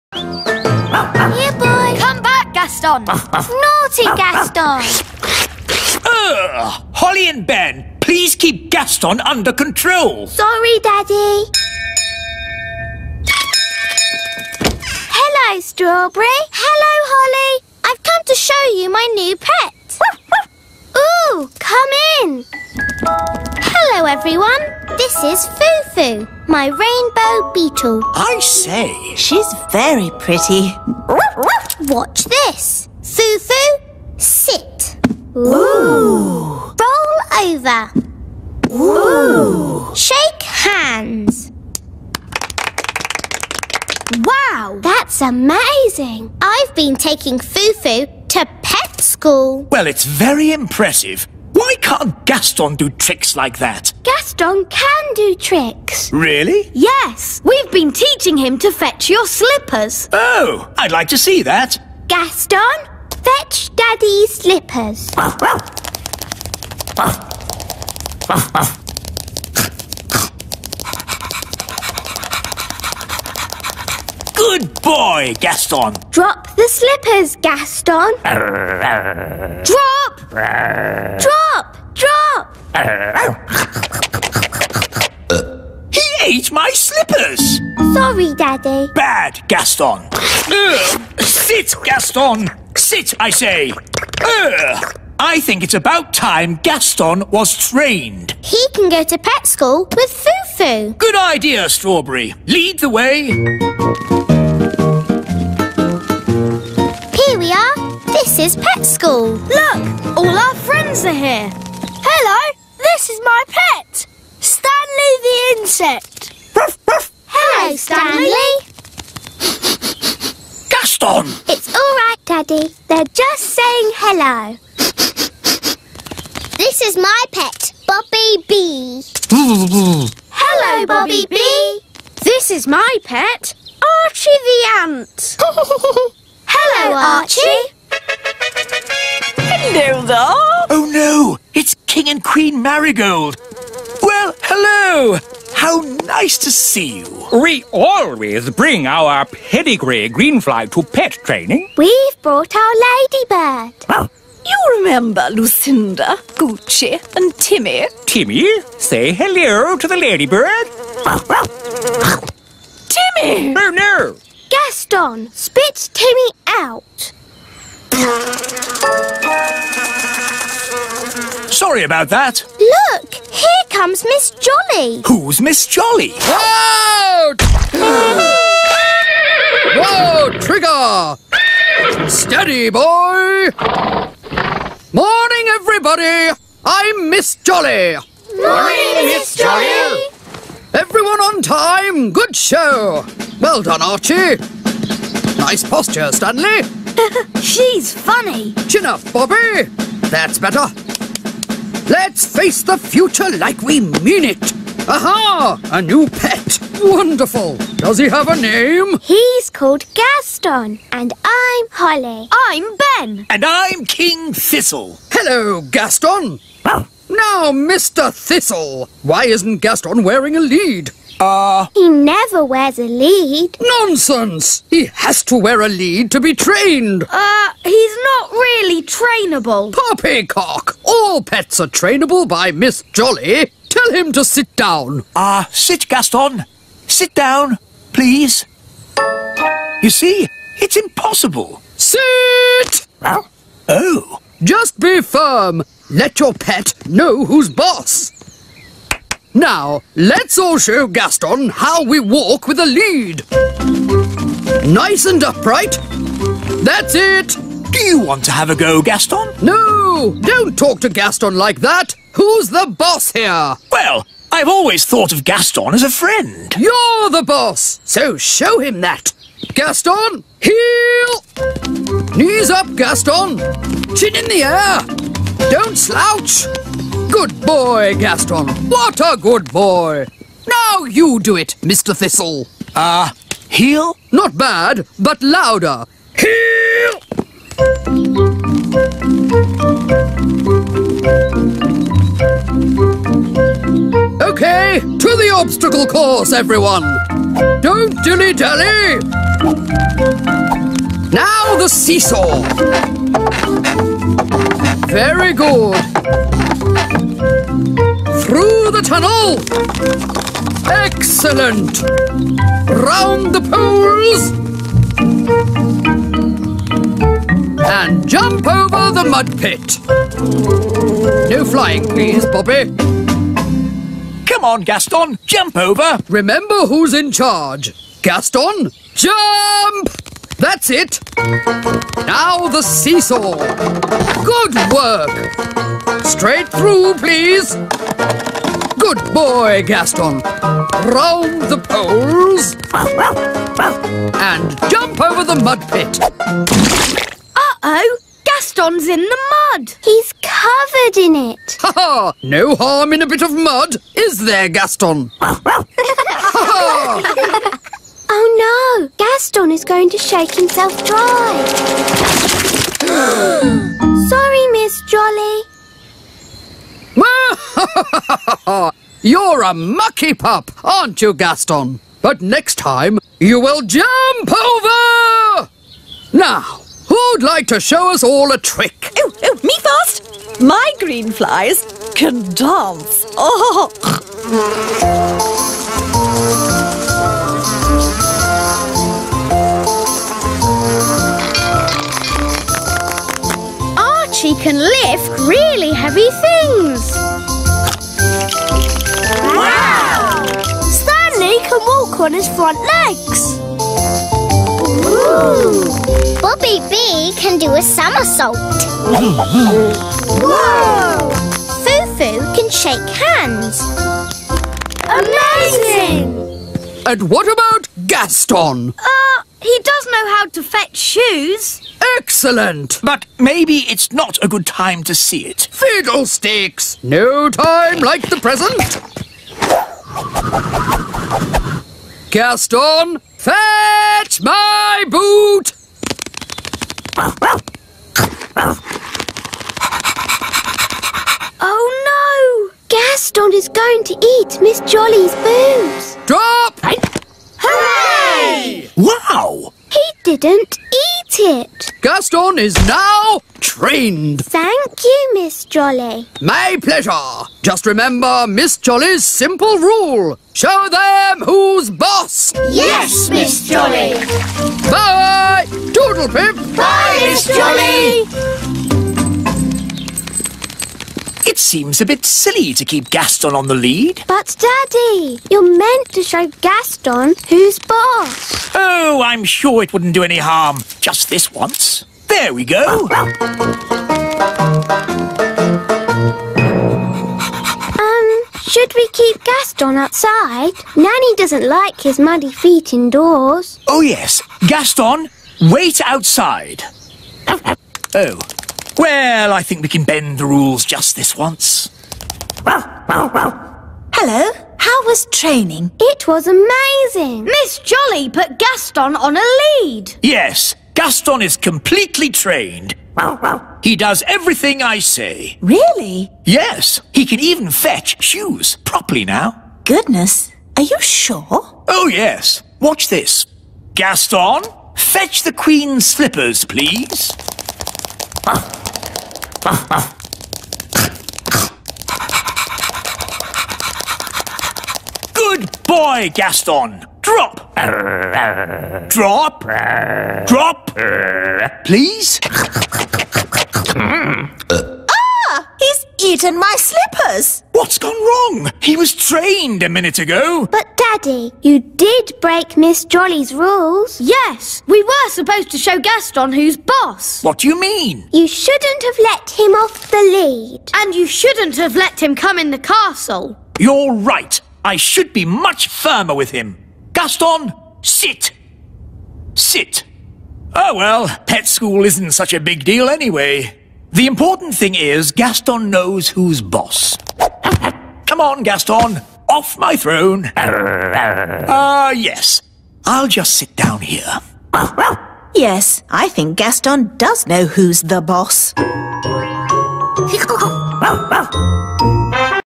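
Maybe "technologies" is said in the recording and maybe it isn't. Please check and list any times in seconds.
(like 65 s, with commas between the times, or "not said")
not said.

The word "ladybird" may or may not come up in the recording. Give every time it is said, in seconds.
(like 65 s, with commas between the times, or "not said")
152 s, 159 s.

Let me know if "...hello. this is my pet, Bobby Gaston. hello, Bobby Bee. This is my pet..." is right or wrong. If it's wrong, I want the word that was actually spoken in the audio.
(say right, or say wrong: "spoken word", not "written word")
wrong: "Bee", not "Gaston".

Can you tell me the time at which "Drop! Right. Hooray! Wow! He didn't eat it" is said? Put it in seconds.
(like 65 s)
446 s.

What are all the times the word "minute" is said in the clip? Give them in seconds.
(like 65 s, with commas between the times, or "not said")
549 s.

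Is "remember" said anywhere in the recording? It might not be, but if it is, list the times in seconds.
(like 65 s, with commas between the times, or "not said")
154 s, 326 s, 457 s.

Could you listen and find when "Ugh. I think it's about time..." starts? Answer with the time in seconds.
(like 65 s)
94 s.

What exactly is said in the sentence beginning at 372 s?
But next time, you will jump over!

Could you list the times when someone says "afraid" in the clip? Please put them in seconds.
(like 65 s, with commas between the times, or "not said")
not said.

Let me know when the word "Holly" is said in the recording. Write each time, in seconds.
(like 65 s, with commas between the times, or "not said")
6 s, 17 s, 211 s.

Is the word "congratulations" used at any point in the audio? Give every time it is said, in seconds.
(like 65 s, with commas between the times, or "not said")
not said.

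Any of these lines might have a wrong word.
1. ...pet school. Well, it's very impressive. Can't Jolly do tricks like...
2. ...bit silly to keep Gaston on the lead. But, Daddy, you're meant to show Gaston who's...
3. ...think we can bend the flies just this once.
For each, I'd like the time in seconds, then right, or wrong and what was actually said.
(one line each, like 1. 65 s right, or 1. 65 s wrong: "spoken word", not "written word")
1. 48 s wrong: "Gaston", not "Jolly"
2. 471 s right
3. 499 s wrong: "rules", not "flies".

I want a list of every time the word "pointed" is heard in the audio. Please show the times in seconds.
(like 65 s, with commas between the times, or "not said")
not said.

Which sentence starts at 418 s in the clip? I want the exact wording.
Uh, he does know how to fetch shoes.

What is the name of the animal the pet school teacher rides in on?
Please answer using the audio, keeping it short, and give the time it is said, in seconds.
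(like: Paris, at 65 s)
Trigger, at 180 s.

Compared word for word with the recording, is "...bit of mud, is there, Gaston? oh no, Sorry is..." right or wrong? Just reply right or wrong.
wrong.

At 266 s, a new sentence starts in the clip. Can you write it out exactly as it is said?
You're the boss, so show him that.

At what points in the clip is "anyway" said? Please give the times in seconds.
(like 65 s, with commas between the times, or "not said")
572 s.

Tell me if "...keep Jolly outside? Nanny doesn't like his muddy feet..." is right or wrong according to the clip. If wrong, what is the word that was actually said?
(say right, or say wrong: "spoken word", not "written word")
wrong: "Gaston", not "Jolly".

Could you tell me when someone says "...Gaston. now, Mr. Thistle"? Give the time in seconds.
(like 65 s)
215 s.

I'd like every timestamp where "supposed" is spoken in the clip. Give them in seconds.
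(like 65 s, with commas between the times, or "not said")
555 s.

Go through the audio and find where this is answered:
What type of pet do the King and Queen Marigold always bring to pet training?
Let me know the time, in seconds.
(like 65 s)
149 s.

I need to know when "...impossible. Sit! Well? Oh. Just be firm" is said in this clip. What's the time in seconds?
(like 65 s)
240 s.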